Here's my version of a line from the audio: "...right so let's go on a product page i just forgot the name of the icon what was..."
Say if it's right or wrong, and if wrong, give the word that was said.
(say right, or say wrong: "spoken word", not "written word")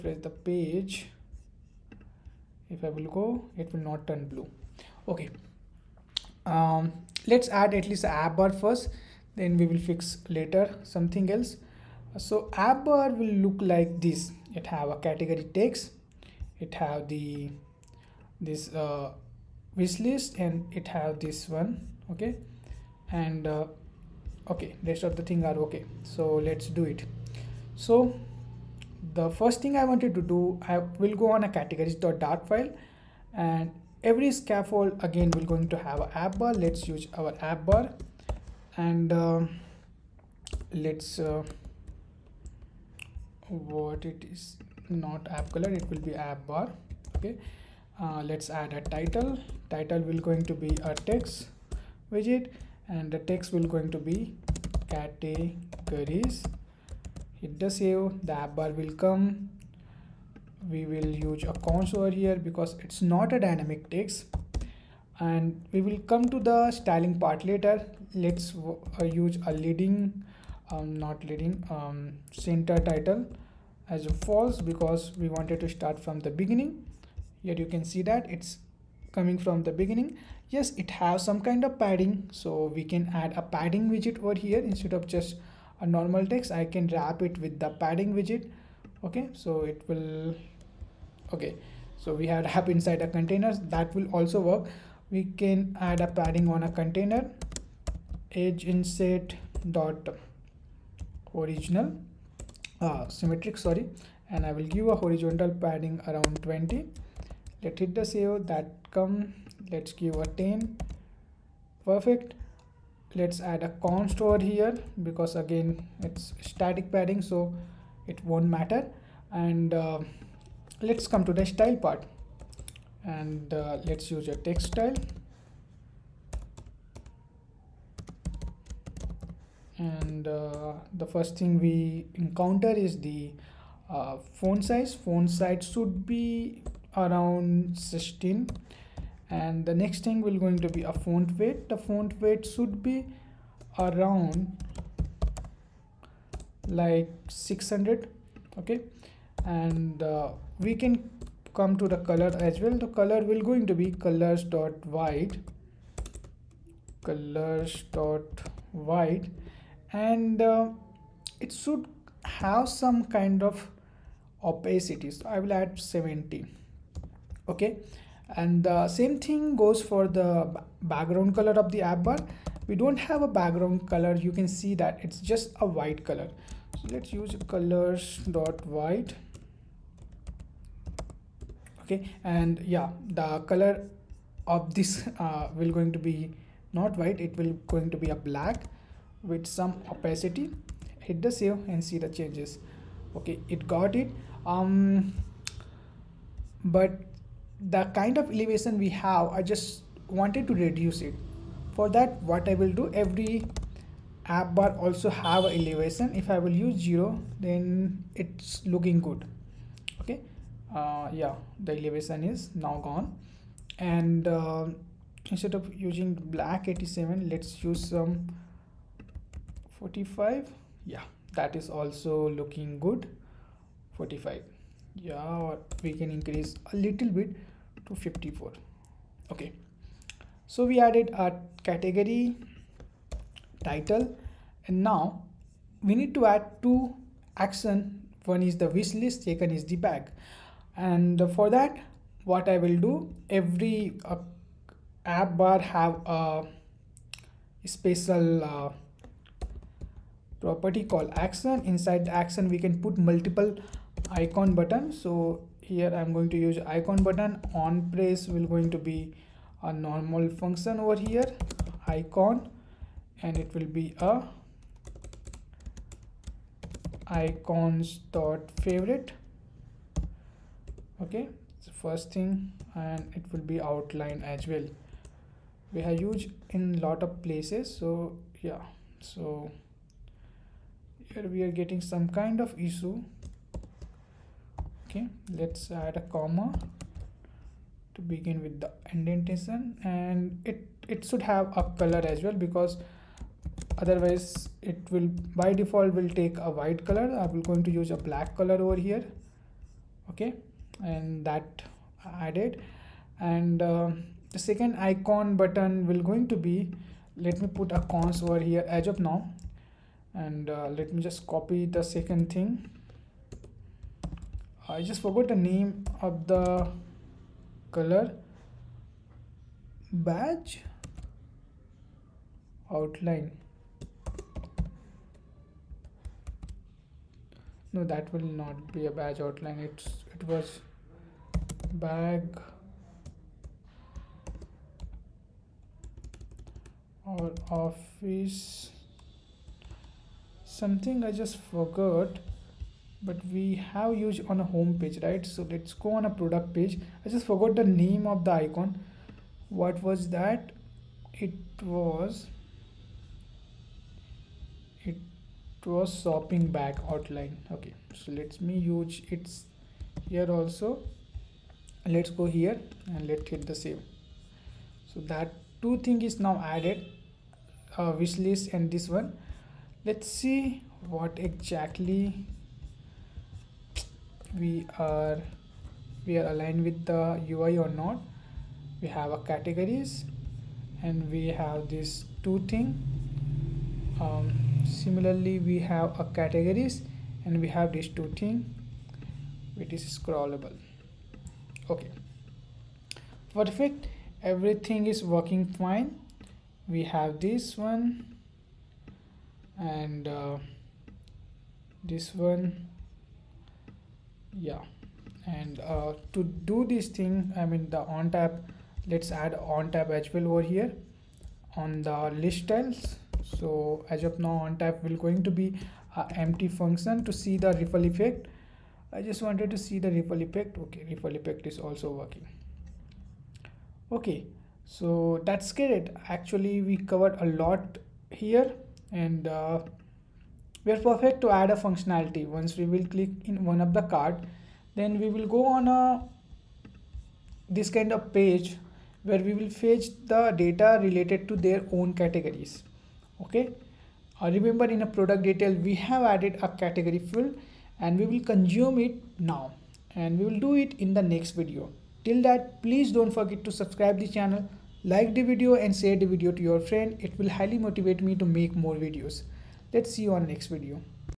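right.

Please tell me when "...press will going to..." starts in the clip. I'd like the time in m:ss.
4:17.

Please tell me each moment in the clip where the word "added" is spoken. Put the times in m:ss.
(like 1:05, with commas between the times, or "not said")
3:50, 5:02, 6:06, 7:26.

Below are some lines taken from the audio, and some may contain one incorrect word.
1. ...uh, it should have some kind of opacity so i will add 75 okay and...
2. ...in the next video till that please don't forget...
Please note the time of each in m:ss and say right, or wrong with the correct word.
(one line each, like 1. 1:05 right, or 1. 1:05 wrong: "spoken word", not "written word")
1. 2:40 wrong: "70", not "75"
2. 7:30 right.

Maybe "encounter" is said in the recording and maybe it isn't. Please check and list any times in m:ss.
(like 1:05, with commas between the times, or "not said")
2:12.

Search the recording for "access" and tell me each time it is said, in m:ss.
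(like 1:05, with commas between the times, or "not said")
not said.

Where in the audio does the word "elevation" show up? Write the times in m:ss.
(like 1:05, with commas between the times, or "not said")
3:18, 3:25, 3:31.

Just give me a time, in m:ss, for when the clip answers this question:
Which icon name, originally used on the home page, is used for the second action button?
5:56.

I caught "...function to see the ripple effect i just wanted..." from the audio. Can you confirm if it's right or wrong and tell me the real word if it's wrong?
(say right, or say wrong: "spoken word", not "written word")
right.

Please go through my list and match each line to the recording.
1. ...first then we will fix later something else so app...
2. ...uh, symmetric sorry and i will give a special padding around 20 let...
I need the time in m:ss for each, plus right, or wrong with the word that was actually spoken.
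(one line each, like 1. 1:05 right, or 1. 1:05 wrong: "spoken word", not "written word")
1. 0:08 right
2. 1:42 wrong: "horizontal", not "special".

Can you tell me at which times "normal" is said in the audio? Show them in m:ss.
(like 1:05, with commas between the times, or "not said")
1:25, 4:19.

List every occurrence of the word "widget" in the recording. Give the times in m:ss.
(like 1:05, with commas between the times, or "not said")
0:52, 1:23, 1:28.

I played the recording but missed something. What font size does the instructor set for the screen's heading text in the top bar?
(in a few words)
16.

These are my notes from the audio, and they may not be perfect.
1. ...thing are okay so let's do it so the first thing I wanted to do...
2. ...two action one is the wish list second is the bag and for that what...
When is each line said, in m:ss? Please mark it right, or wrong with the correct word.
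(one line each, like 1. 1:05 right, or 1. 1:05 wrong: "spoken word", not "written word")
1. 0:25 right
2. 3:56 right.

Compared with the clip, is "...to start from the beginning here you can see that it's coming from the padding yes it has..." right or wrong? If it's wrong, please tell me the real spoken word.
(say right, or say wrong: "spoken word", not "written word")
wrong: "beginning", not "padding".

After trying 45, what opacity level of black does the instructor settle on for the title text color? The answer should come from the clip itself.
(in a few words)
54.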